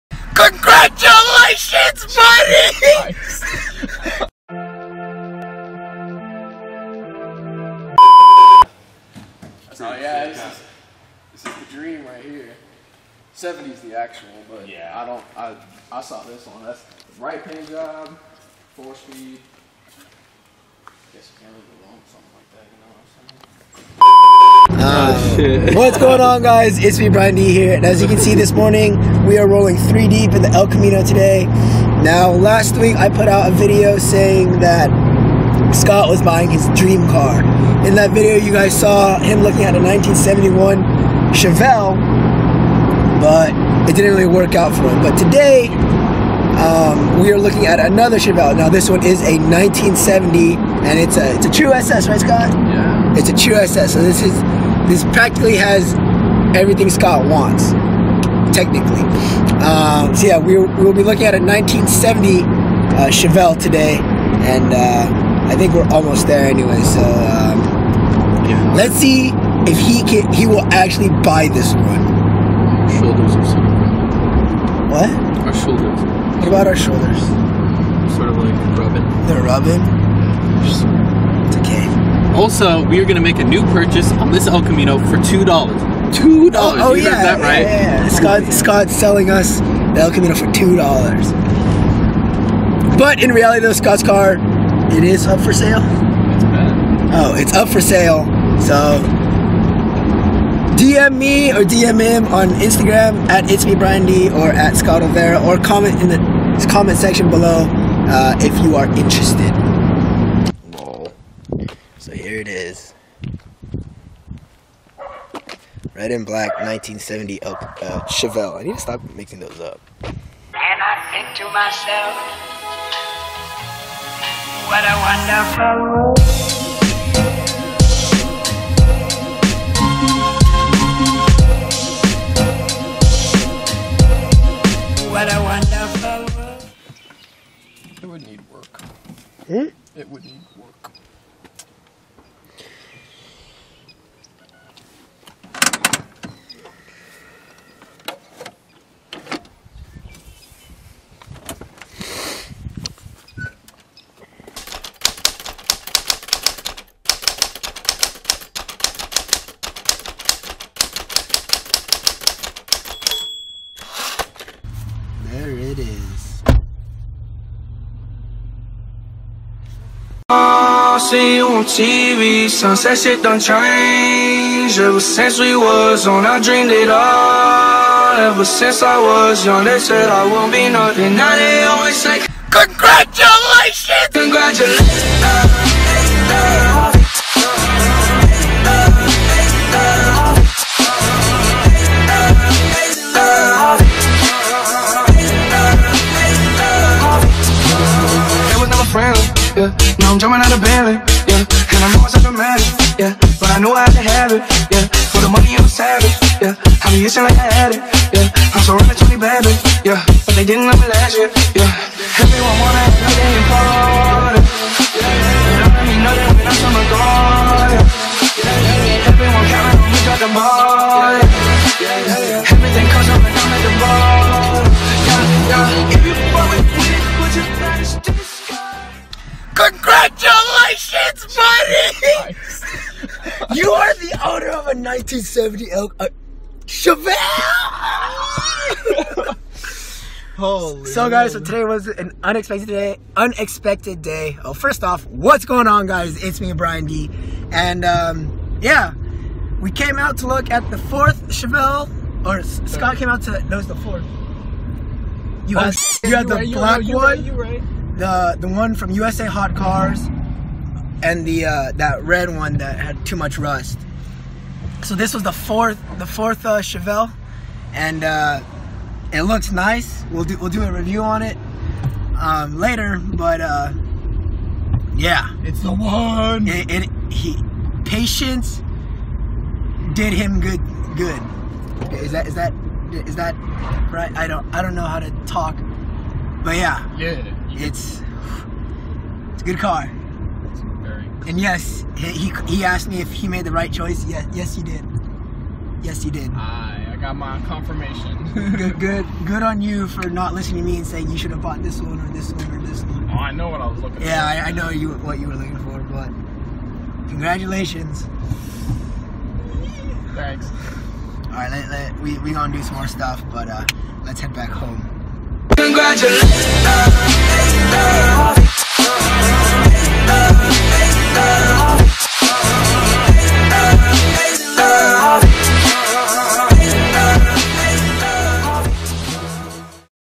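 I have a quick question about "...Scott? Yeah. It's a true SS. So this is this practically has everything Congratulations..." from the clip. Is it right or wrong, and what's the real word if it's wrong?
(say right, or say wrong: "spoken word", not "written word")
wrong: "Scott", not "Congratulations".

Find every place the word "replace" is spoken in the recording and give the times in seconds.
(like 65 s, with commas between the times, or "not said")
not said.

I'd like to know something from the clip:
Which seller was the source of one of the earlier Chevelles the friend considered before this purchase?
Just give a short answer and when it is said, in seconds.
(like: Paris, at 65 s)
USA Hot Cars, at 258 s.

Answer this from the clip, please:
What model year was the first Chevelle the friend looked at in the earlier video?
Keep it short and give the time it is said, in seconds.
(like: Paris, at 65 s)
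1971, at 39 s.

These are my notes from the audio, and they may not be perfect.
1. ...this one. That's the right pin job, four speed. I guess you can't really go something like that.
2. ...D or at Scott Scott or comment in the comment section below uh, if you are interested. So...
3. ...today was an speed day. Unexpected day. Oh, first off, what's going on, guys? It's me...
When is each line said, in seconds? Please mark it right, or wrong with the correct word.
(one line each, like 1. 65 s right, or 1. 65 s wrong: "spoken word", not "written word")
1. 16 s right
2. 104 s wrong: "Olvera", not "Scott"
3. 241 s wrong: "unexpected", not "speed".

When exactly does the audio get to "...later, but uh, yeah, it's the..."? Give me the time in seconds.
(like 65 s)
272 s.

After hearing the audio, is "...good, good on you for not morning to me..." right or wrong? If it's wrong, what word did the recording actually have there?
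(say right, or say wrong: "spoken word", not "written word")
wrong: "listening", not "morning".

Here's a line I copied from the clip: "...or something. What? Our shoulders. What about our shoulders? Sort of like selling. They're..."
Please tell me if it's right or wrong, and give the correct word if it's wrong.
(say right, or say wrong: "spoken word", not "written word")
wrong: "rubbing", not "selling".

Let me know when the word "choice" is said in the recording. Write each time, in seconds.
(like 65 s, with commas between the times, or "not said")
293 s.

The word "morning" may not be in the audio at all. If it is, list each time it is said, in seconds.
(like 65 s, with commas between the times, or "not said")
28 s.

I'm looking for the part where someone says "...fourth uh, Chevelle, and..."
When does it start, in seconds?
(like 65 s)
266 s.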